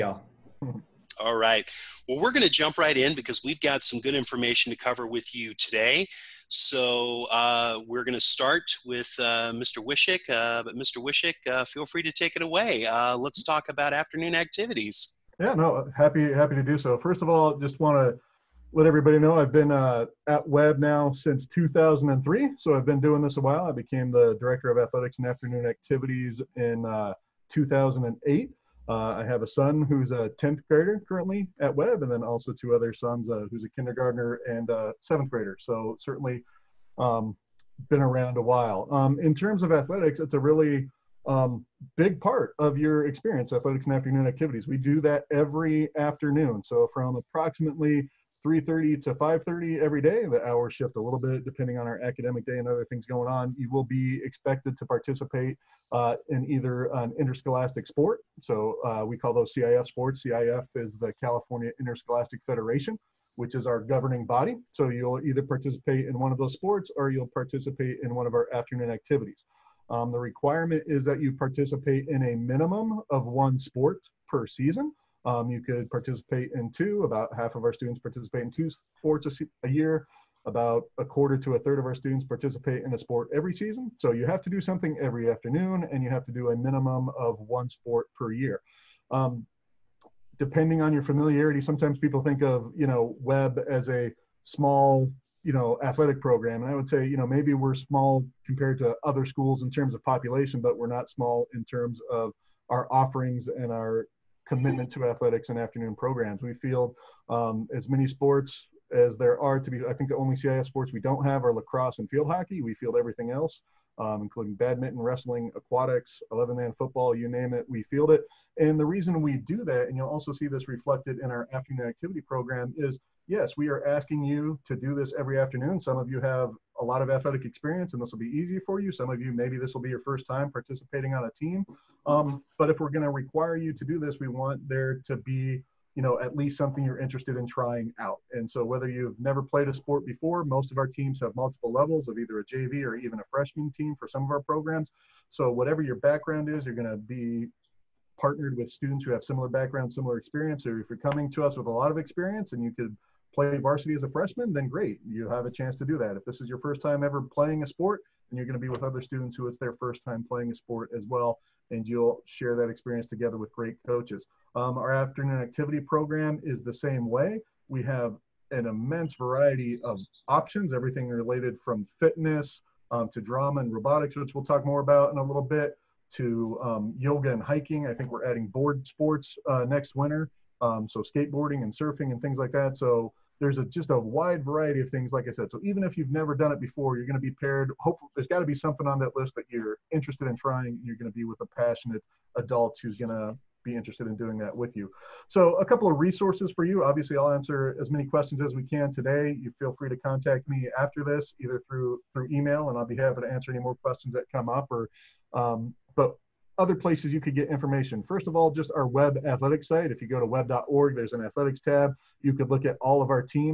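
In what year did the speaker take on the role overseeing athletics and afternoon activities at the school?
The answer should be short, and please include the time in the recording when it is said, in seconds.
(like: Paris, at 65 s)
2008, at 27 s.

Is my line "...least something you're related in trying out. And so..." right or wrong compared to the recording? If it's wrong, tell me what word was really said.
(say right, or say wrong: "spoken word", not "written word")
wrong: "interested", not "related".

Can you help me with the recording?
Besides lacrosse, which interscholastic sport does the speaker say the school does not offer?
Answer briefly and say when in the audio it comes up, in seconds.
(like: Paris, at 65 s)
Field hockey, at 112 s.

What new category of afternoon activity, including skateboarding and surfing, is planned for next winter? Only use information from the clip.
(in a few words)
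Board sports.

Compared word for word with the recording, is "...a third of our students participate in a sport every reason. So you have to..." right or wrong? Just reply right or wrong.
wrong.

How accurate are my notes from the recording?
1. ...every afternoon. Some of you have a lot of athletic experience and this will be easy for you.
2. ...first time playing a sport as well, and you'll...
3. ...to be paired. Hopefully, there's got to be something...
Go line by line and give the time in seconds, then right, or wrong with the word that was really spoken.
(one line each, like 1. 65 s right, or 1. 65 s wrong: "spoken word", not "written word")
1. 125 s right
2. 159 s right
3. 187 s right.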